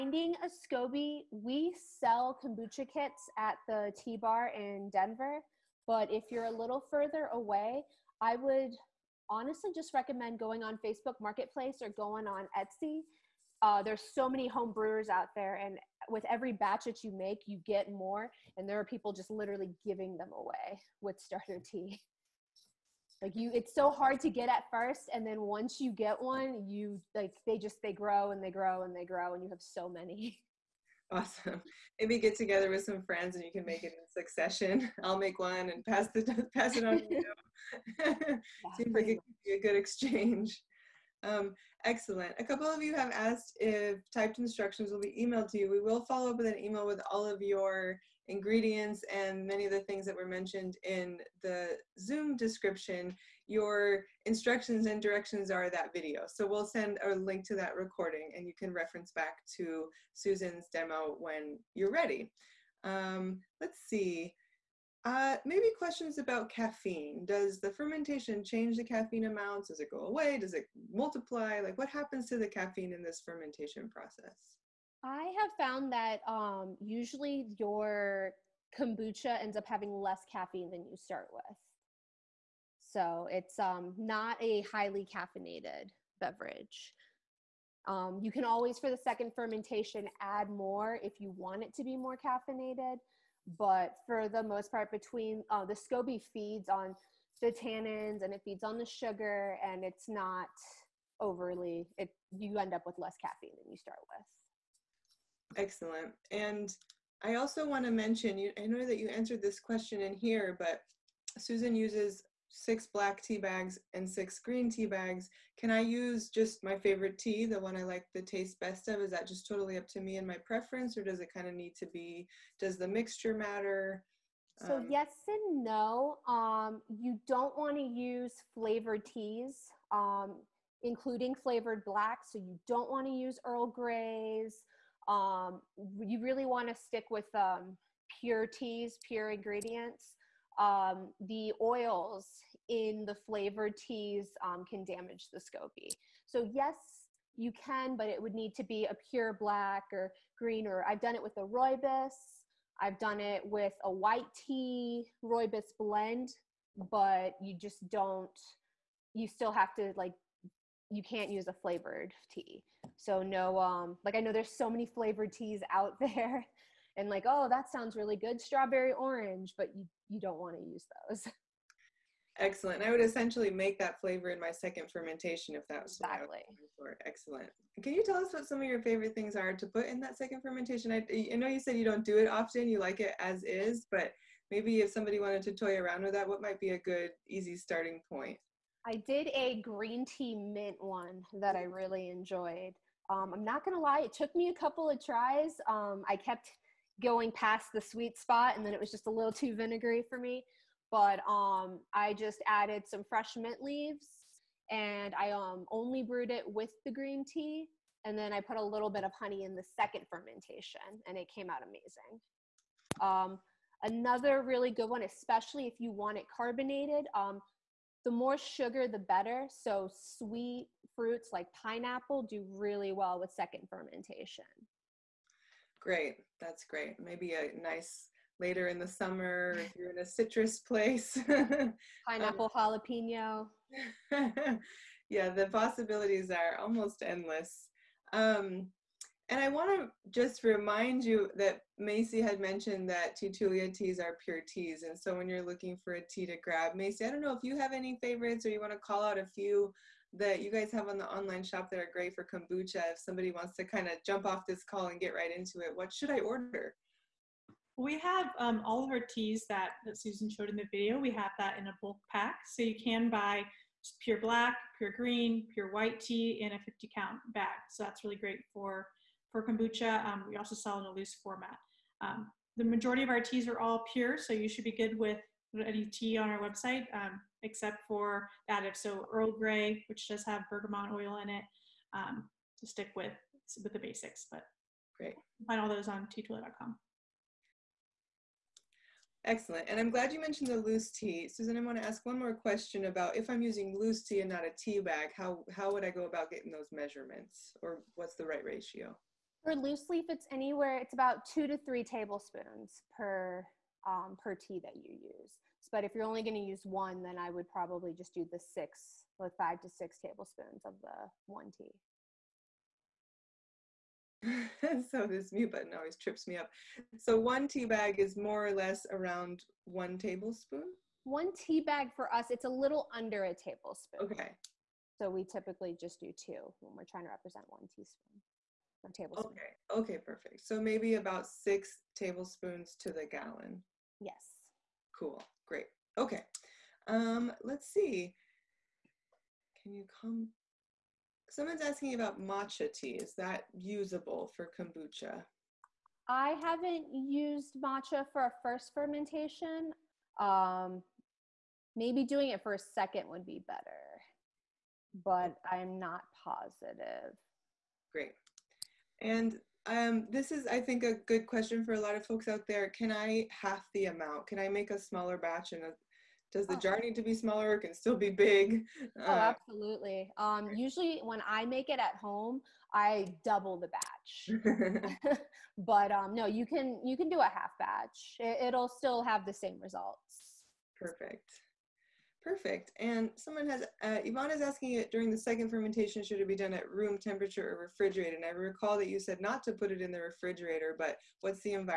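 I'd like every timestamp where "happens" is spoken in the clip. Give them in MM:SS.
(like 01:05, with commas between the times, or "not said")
01:11.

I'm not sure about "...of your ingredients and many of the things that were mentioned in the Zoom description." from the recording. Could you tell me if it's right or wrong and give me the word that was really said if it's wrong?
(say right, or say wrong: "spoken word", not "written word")
right.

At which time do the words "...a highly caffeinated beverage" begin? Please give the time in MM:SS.
01:24.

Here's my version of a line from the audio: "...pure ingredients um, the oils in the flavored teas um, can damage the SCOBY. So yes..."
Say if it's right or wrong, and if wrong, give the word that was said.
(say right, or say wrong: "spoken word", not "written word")
right.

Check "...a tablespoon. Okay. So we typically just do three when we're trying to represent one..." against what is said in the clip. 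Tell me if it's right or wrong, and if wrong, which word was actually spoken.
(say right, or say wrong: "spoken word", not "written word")
wrong: "two", not "three".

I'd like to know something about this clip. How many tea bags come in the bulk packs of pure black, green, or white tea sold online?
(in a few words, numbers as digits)
50.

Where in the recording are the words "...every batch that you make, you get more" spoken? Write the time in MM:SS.
00:16.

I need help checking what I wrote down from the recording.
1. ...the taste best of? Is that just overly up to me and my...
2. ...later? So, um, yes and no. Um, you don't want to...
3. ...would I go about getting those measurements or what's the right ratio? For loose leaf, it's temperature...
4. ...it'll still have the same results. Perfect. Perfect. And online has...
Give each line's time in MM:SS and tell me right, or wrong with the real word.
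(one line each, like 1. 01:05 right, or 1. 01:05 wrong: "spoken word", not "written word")
1. 01:58 wrong: "totally", not "overly"
2. 02:03 wrong: "matter", not "later"
3. 04:55 wrong: "anywhere", not "temperature"
4. 06:18 wrong: "someone", not "online".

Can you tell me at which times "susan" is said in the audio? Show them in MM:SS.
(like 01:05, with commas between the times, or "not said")
01:00, 01:51, 04:19, 04:51.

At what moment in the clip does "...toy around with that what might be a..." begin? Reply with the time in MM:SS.
03:05.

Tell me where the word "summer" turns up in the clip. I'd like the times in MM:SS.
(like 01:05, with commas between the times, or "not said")
03:48.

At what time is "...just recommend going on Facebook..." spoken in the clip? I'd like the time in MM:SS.
00:09.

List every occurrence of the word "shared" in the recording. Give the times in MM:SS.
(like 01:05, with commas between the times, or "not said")
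not said.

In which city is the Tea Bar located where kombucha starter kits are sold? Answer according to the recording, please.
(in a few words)
Denver.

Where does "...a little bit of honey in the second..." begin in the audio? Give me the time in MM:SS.
03:28.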